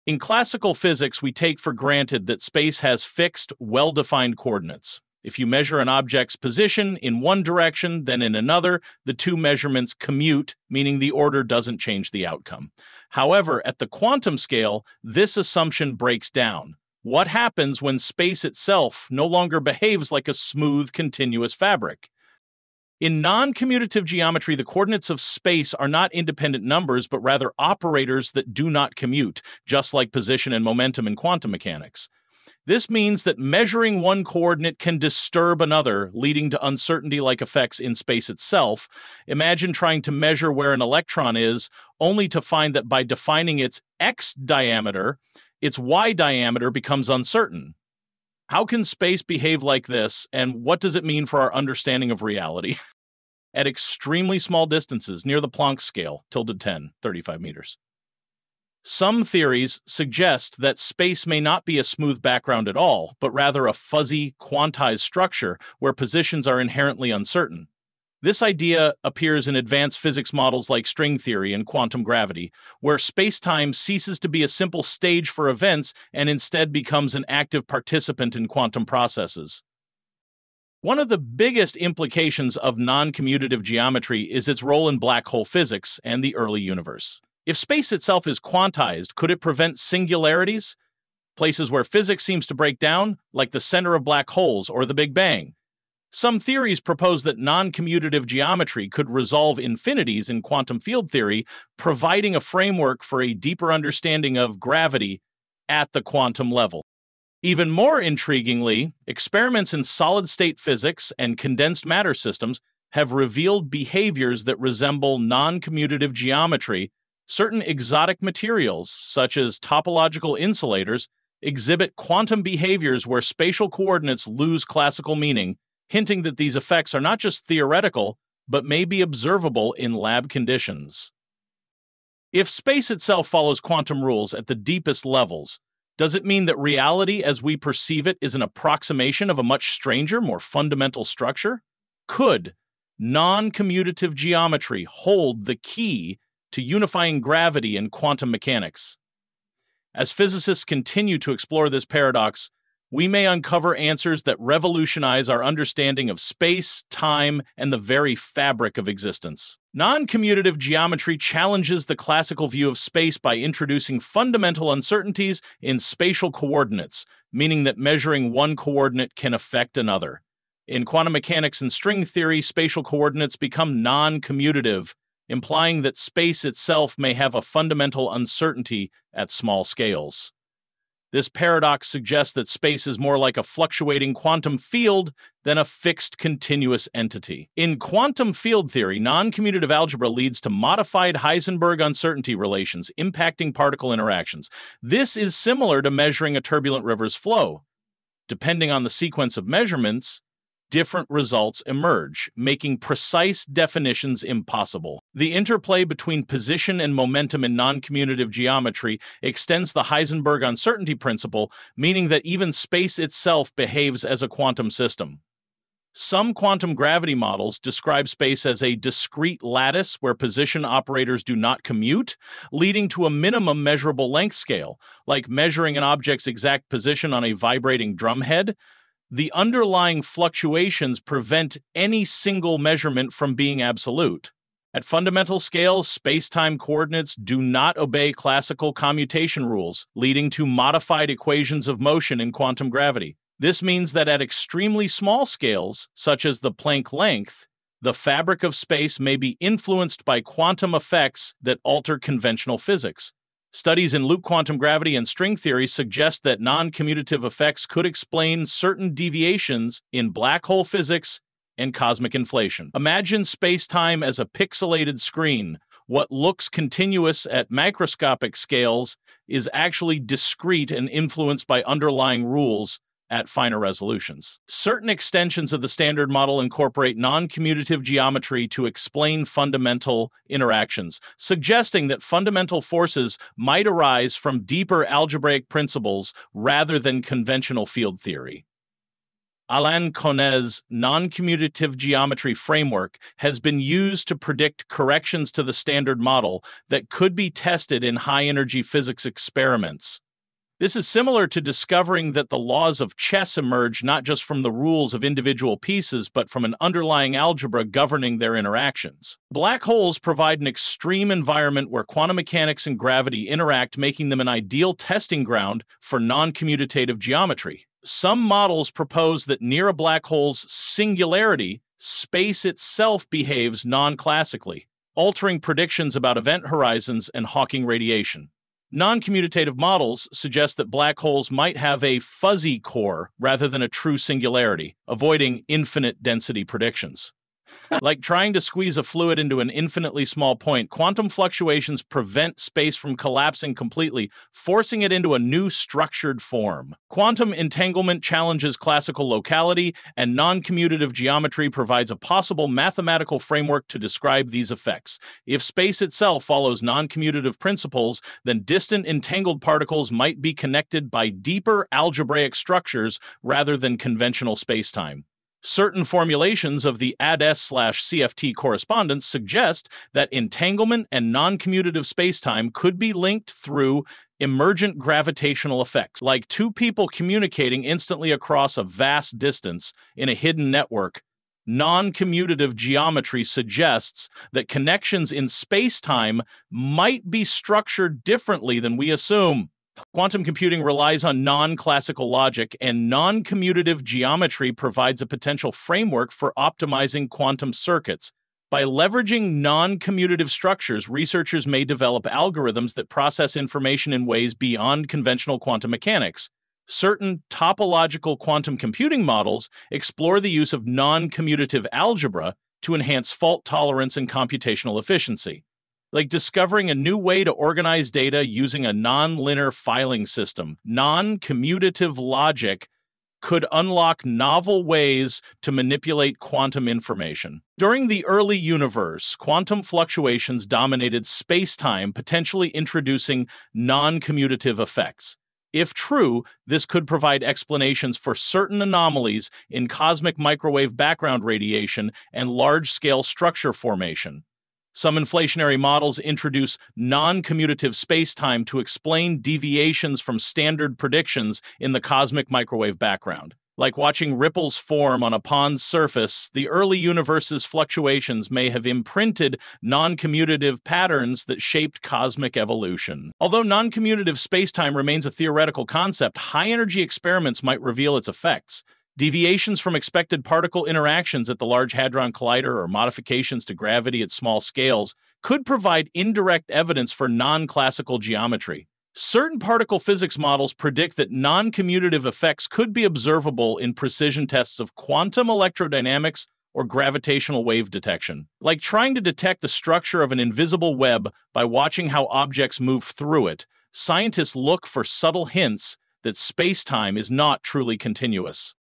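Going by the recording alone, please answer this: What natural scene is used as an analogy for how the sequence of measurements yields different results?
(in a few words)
a turbulent river's flow.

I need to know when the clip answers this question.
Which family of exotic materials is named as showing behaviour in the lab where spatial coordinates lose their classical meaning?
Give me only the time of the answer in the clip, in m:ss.
1:59.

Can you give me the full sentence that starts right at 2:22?
Could non commutative geometry hold the key to unifying gravity and quantum mechanics?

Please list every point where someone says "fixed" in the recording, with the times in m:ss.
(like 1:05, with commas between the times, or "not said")
0:03, 3:05.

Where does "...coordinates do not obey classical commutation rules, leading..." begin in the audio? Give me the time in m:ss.
3:56.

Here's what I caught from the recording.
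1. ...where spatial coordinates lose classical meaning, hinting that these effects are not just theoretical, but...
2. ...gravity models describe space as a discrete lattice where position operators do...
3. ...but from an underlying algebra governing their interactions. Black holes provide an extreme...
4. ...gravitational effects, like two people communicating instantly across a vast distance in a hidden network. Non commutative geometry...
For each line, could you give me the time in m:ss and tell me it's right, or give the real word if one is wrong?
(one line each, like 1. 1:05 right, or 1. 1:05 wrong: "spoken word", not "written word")
1. 2:03 right
2. 3:36 right
3. 5:06 right
4. 6:14 right.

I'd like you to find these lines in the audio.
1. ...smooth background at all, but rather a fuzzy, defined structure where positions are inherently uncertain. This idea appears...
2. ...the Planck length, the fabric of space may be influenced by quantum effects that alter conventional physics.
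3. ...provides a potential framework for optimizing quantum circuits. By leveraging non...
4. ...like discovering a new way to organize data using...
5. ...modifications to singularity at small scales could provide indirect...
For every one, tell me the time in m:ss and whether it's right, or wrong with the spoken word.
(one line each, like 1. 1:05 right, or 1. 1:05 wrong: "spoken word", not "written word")
1. 1:01 wrong: "quantized", not "defined"
2. 4:06 right
3. 6:34 right
4. 6:55 right
5. 7:52 wrong: "gravity", not "singularity".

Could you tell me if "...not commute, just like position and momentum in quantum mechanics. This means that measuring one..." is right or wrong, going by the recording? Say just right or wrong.
right.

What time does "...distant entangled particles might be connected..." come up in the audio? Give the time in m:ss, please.
5:58.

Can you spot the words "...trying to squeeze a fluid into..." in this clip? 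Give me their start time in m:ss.
5:38.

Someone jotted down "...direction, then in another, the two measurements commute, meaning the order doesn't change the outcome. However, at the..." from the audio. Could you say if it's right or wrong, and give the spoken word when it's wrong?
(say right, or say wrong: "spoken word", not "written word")
right.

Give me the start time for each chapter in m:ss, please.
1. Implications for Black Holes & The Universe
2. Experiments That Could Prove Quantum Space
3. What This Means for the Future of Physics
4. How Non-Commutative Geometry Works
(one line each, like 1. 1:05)
1. 3:30
2. 5:15
3. 7:00
4. 1:45.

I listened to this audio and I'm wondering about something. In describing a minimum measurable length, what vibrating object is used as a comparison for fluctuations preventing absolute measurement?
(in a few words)
drumhead.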